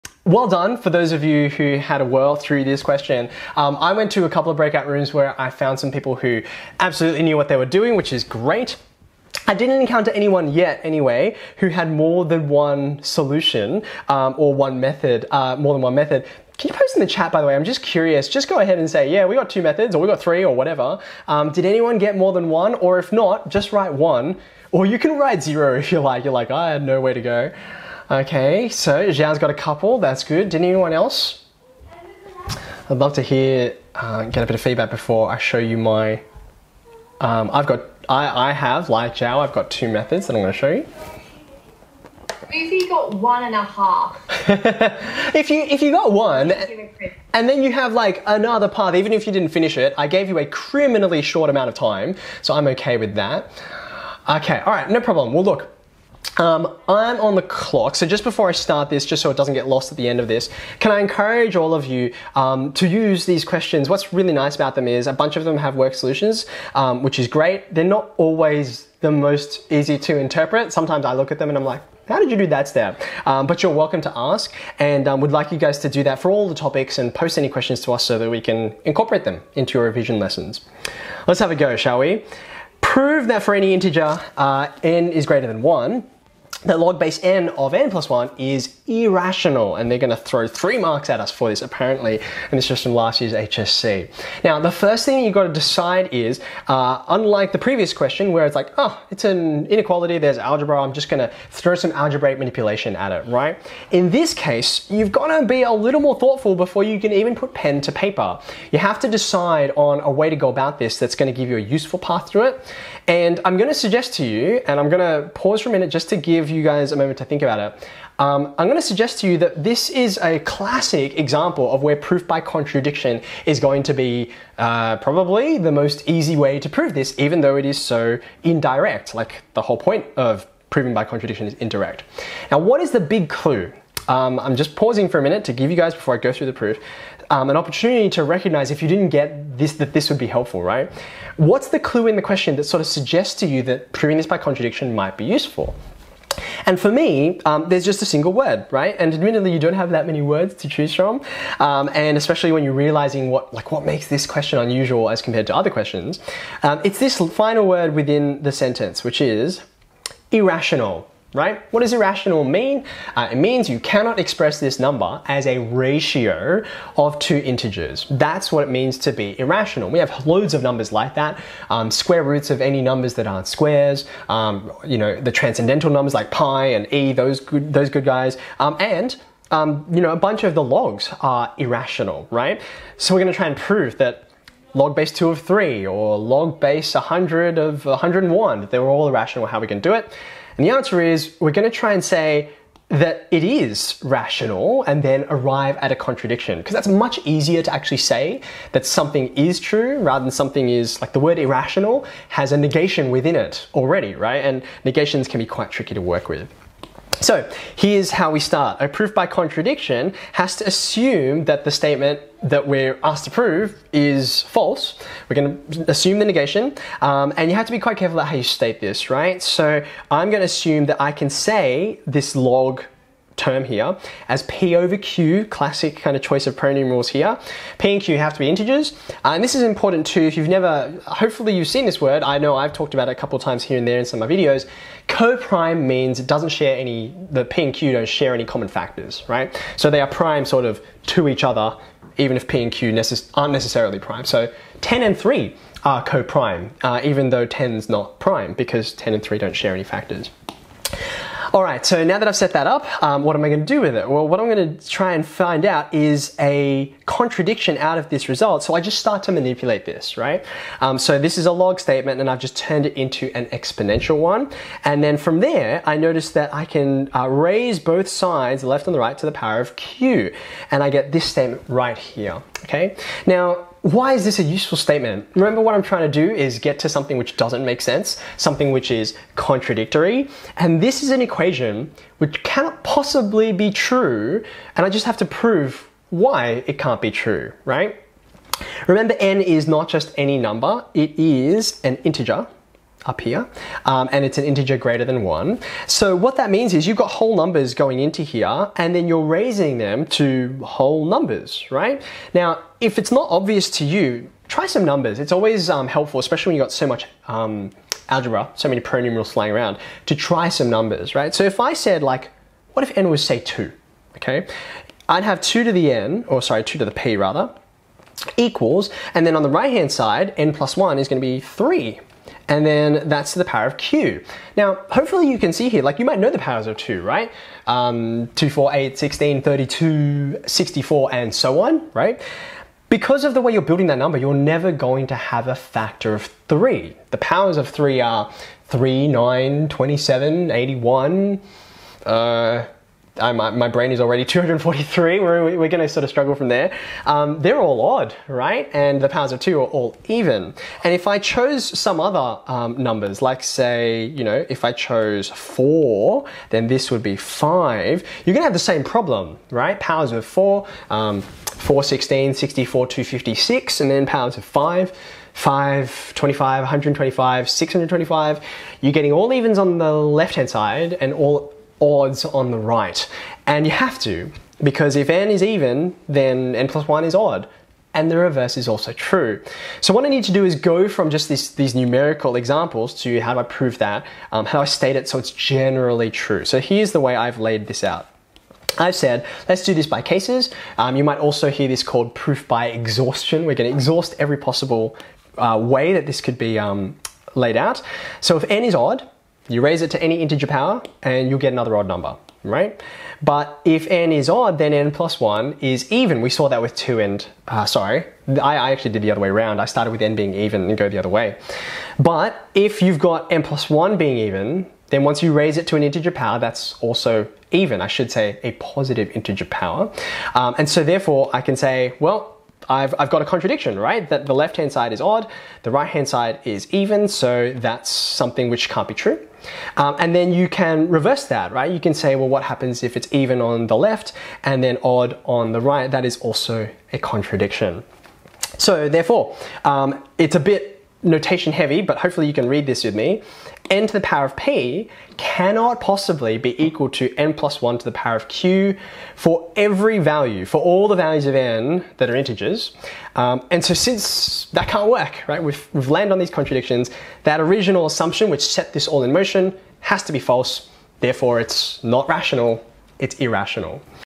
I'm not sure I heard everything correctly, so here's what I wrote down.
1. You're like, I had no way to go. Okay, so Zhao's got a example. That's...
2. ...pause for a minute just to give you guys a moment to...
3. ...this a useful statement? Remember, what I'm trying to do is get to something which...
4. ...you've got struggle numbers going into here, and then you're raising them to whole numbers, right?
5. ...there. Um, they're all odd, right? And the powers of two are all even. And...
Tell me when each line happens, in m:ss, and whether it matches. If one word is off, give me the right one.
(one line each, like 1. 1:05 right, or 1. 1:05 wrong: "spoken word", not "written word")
1. 0:26 wrong: "couple", not "example"
2. 1:55 right
3. 4:34 right
4. 4:56 wrong: "whole", not "struggle"
5. 5:46 right.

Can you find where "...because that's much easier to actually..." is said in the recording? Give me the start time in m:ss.
3:16.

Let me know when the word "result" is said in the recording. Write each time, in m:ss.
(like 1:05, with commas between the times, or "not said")
4:18.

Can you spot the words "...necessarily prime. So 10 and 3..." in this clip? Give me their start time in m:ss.
4:03.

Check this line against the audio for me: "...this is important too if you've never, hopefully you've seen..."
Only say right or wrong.
right.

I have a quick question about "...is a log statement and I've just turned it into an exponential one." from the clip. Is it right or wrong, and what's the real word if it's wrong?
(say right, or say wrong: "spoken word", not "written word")
right.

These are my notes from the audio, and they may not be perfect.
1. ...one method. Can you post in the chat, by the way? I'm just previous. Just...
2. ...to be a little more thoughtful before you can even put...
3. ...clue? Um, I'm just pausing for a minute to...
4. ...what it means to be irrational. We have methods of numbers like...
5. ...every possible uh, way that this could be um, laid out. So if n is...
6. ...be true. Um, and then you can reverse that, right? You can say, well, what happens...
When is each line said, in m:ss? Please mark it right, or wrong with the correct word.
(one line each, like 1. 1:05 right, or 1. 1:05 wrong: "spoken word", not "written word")
1. 0:15 wrong: "curious", not "previous"
2. 1:45 right
3. 2:13 right
4. 2:48 wrong: "loads", not "methods"
5. 6:34 right
6. 7:08 right.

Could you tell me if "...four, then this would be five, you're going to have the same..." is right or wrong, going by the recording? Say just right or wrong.
right.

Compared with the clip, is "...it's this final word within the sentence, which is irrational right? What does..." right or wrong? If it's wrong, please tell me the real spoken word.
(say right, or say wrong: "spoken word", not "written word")
right.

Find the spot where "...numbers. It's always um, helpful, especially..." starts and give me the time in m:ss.
5:04.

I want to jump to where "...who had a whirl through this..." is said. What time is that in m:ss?
0:01.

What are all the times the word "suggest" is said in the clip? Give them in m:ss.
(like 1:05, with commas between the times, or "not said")
1:53, 1:58, 2:22.